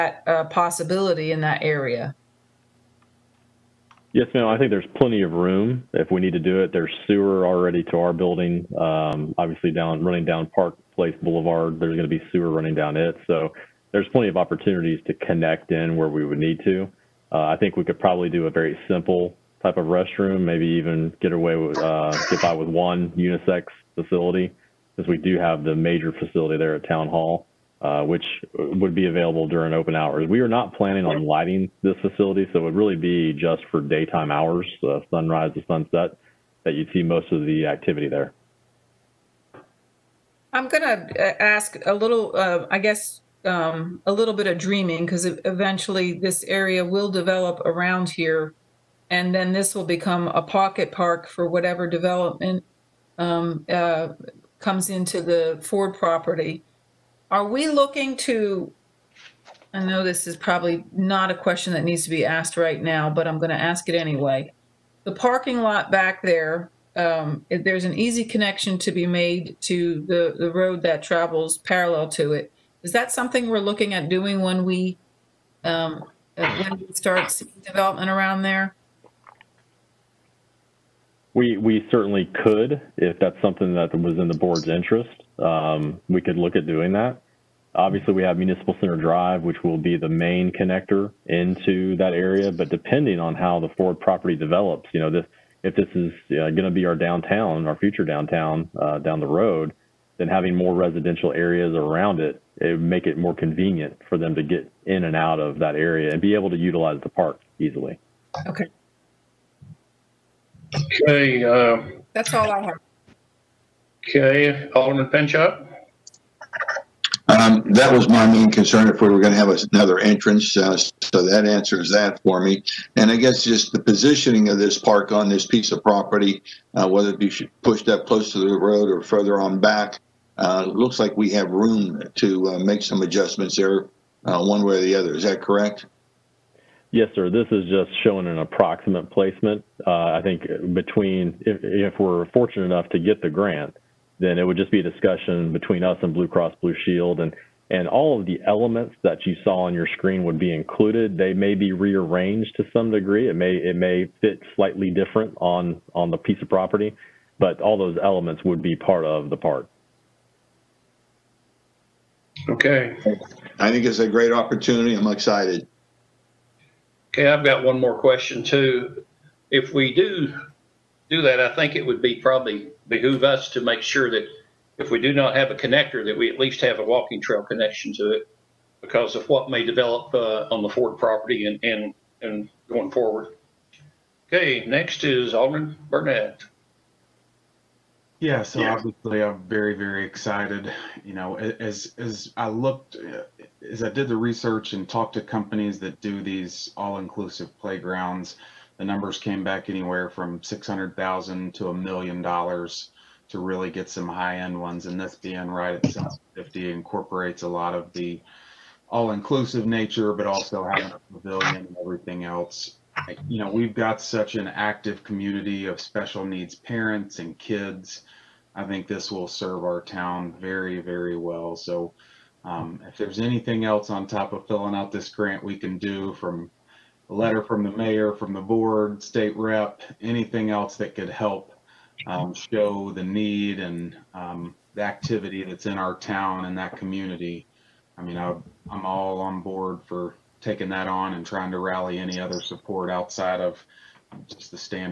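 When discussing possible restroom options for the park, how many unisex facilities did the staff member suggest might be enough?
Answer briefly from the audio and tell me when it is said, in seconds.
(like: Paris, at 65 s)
1, at 22 s.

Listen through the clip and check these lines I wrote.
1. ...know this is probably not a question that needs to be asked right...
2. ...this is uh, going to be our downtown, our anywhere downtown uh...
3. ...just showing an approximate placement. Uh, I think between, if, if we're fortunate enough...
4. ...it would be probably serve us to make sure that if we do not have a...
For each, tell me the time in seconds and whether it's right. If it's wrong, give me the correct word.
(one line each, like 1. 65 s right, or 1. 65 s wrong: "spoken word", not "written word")
1. 59 s right
2. 95 s wrong: "future", not "anywhere"
3. 137 s right
4. 171 s wrong: "behoove", not "serve".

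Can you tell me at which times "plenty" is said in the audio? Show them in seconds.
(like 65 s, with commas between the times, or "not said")
4 s, 14 s.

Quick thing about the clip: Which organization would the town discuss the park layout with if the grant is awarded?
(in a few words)
Blue Cross Blue Shield.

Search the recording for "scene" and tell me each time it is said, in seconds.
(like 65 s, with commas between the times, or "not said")
not said.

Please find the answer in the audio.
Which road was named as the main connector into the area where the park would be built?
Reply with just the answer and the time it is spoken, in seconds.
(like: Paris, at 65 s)
Municipal Center Drive, at 88 s.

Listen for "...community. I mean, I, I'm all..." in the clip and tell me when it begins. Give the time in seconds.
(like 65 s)
236 s.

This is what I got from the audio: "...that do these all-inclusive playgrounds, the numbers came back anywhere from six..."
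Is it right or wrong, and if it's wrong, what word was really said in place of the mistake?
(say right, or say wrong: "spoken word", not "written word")
right.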